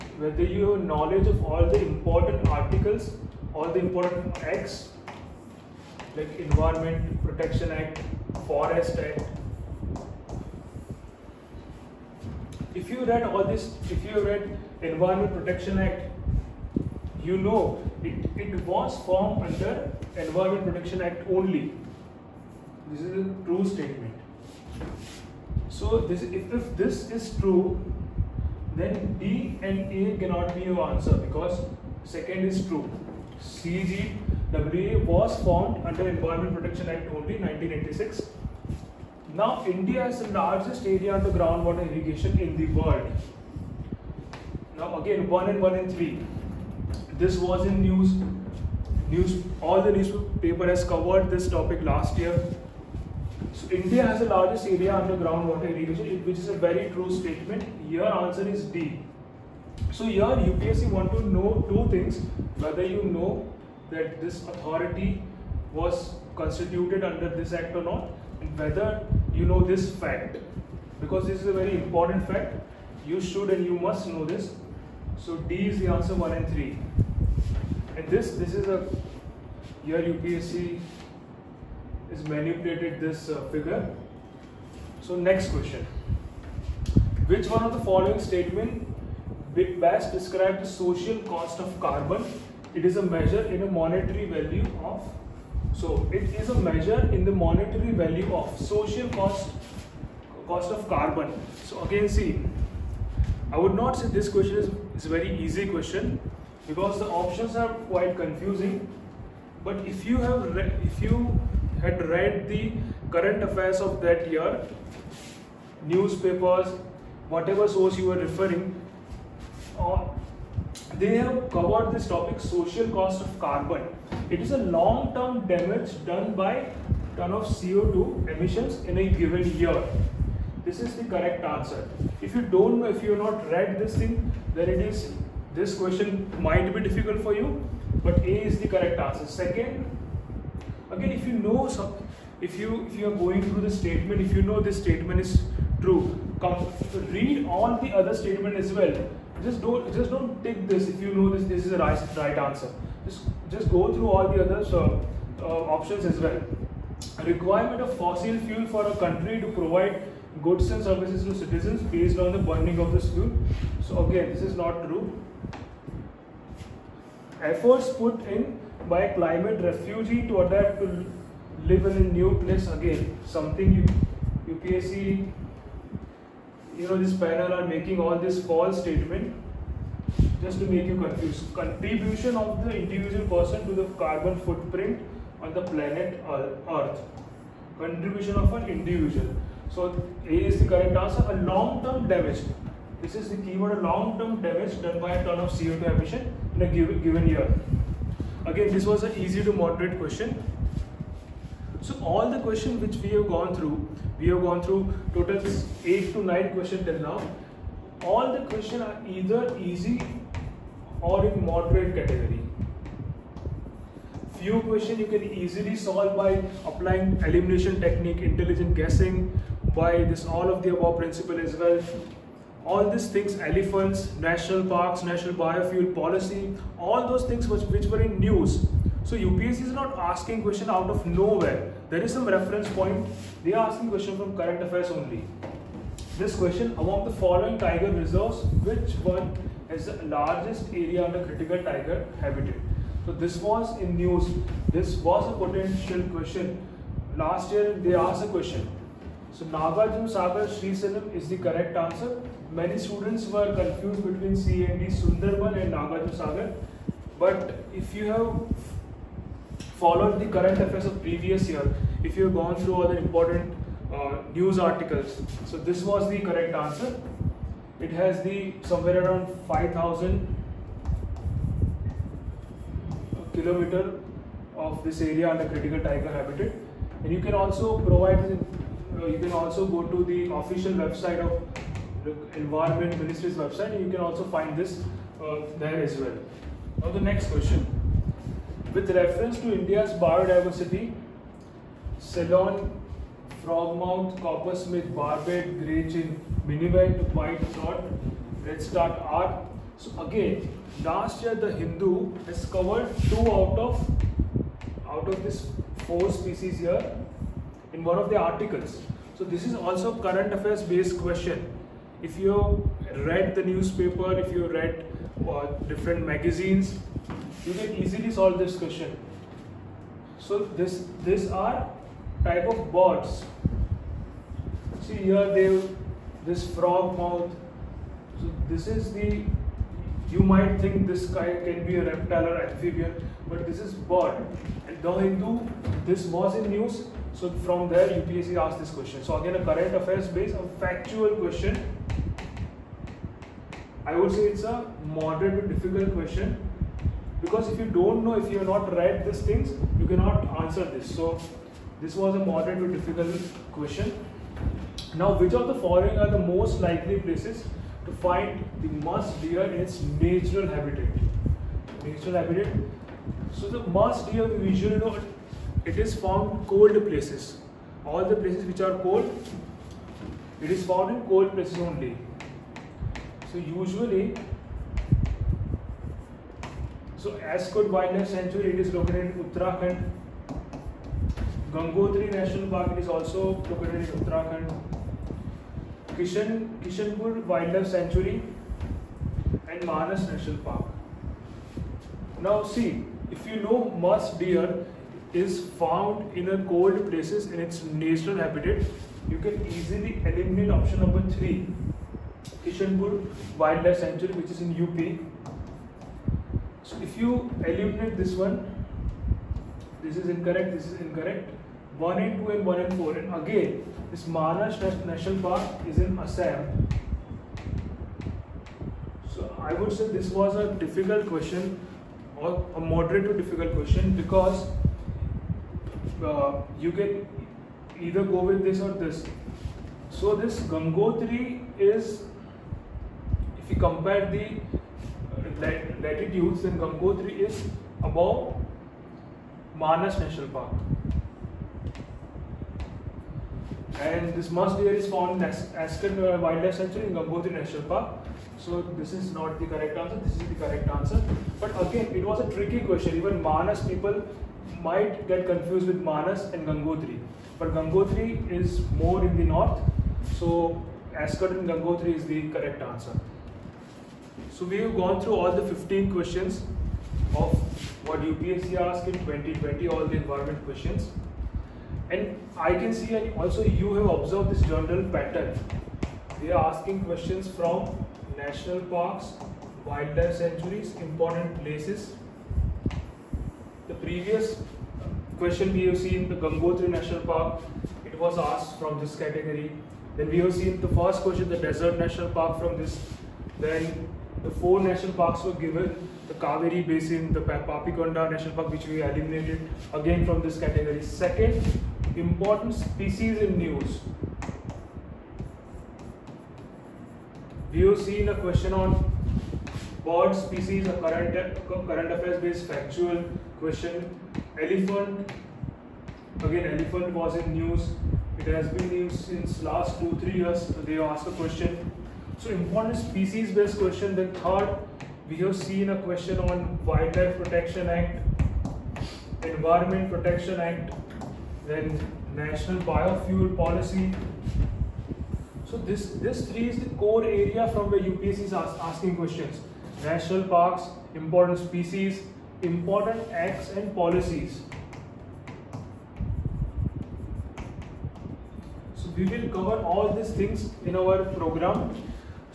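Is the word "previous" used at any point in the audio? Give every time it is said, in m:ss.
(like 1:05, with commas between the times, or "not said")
4:21, 8:03.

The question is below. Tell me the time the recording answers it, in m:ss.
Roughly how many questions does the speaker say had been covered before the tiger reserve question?
3:25.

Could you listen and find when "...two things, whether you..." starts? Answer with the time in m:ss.
1:01.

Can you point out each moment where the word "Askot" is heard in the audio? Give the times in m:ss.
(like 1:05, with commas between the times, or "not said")
6:17, 7:40.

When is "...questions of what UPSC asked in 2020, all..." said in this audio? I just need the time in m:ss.
7:45.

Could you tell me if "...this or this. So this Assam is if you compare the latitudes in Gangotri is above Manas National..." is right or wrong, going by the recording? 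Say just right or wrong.
wrong.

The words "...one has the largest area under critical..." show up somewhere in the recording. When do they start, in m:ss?
3:59.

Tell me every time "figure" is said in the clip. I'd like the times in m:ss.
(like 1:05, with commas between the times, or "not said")
1:23.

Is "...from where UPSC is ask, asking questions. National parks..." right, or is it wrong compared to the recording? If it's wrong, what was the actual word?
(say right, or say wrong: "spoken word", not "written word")
right.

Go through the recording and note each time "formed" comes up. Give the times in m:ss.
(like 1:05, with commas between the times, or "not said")
0:19, 0:35.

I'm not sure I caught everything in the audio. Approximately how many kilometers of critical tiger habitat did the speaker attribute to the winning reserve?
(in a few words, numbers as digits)
5000.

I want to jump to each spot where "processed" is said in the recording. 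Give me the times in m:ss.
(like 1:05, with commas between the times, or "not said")
not said.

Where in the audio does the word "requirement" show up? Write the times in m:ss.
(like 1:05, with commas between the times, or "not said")
2:37.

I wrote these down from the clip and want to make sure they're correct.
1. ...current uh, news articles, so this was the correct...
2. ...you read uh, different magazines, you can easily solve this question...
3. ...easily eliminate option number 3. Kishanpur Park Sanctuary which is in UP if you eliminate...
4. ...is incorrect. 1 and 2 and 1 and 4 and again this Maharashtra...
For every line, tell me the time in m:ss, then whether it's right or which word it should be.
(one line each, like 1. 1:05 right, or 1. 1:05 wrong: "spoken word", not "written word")
1. 4:22 wrong: "important", not "current"
2. 5:14 right
3. 6:39 wrong: "Wildlife", not "Park"
4. 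6:50 right.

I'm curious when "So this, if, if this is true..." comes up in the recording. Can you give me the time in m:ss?
0:25.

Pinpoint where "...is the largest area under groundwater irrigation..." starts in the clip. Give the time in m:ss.
0:40.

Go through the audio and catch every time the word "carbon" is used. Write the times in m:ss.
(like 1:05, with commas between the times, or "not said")
1:31, 1:40, 2:03, 3:04.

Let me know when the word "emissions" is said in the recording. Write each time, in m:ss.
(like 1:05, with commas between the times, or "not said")
2:08, 3:15.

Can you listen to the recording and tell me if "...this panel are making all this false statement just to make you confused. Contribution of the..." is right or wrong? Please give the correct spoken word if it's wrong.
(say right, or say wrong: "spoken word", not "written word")
right.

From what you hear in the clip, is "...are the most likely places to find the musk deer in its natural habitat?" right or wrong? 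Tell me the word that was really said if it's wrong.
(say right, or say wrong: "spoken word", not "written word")
right.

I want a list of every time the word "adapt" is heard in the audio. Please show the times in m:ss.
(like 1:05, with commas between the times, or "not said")
2:50.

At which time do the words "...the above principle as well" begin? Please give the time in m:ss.
3:40.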